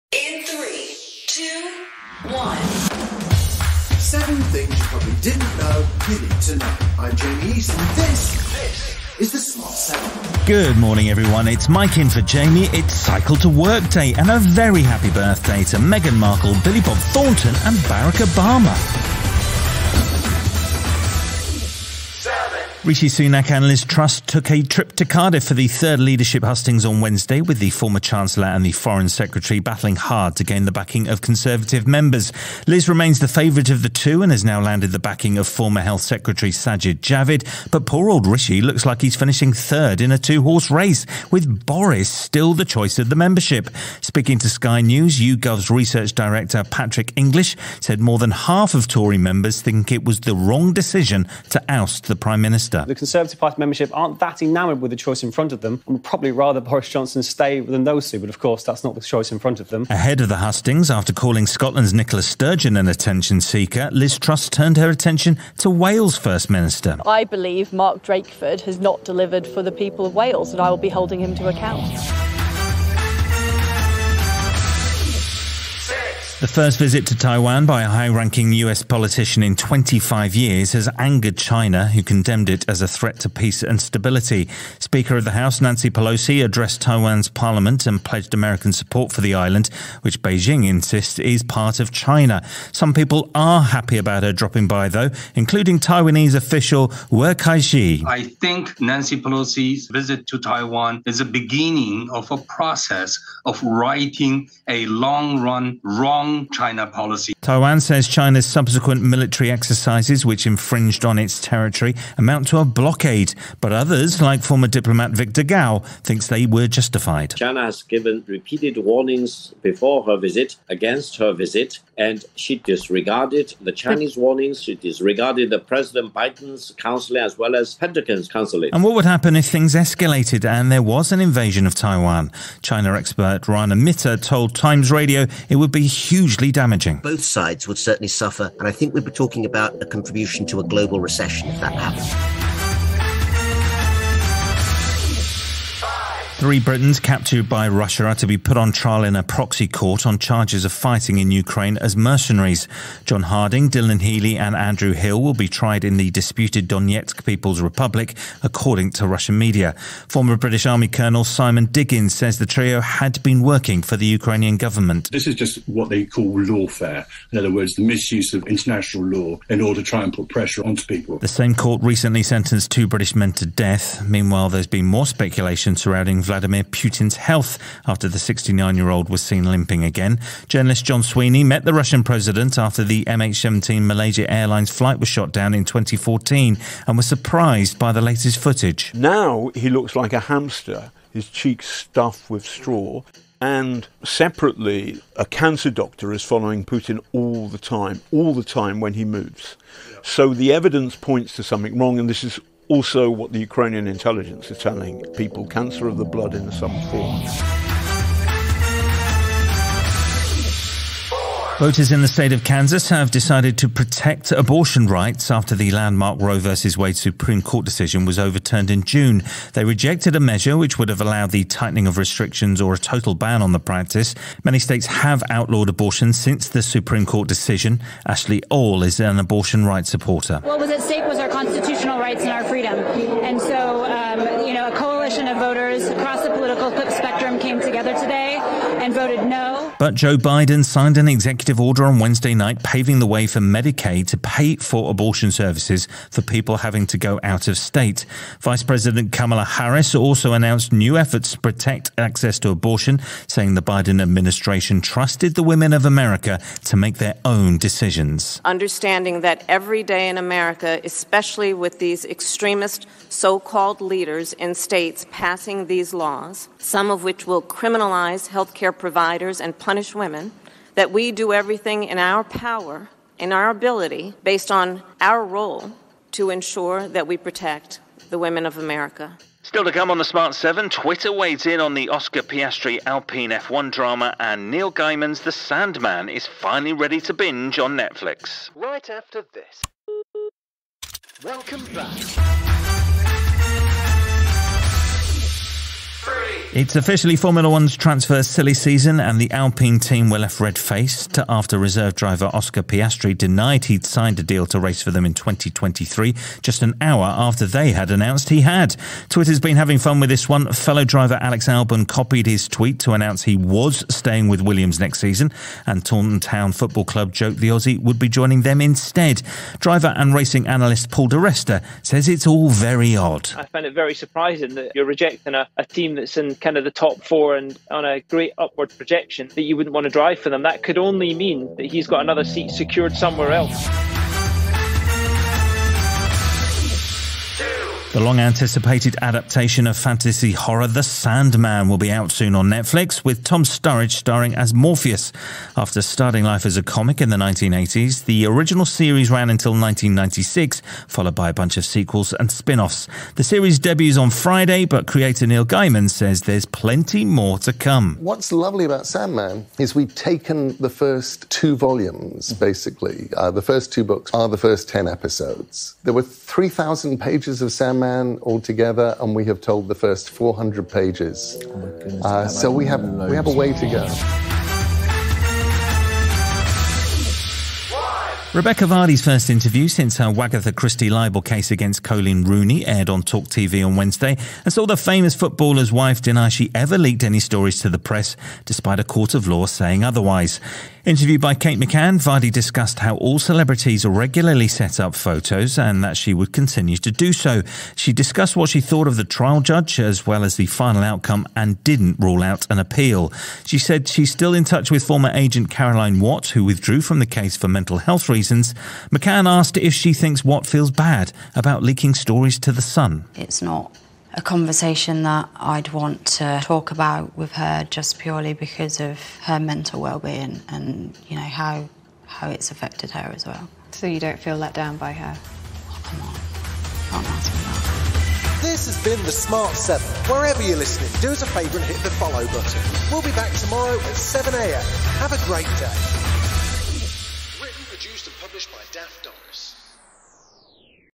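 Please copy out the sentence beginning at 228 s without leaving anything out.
Ashley All is an abortion rights supporter.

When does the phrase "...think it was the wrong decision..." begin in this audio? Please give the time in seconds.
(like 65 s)
49 s.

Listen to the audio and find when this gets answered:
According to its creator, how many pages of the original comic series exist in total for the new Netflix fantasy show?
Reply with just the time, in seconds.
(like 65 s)
366 s.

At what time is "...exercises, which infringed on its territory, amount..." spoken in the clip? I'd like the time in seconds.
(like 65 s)
109 s.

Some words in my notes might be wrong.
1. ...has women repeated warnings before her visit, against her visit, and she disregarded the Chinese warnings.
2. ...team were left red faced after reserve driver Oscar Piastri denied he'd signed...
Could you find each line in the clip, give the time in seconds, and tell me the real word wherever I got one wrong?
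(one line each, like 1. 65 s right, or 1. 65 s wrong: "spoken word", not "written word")
1. 117 s wrong: "given", not "women"
2. 299 s right.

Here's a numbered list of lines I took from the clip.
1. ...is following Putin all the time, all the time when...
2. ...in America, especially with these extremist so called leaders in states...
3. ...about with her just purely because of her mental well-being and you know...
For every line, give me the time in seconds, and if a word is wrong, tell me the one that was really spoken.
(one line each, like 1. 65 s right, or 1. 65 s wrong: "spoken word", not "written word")
1. 196 s right
2. 260 s right
3. 416 s right.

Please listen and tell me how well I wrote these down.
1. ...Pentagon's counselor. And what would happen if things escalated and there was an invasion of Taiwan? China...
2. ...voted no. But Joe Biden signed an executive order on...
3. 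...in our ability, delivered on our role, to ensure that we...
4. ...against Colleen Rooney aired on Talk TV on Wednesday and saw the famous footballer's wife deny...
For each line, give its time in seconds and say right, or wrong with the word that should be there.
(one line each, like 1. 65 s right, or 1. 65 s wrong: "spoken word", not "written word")
1. 127 s right
2. 238 s right
3. 273 s wrong: "based", not "delivered"
4. 381 s right.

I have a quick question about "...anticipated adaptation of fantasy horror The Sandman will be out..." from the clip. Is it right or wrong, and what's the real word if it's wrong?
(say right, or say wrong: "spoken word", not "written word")
right.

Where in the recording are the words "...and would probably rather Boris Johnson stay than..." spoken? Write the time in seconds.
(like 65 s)
55 s.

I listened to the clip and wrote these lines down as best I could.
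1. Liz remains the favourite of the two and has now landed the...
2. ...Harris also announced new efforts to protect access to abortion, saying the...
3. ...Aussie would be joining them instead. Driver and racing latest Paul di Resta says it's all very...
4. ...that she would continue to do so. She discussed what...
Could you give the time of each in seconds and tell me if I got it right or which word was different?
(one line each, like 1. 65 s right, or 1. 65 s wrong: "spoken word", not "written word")
1. 32 s right
2. 249 s right
3. 317 s wrong: "analyst", not "latest"
4. 395 s right.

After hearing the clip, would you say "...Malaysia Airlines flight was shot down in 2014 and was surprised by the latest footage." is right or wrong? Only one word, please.
right.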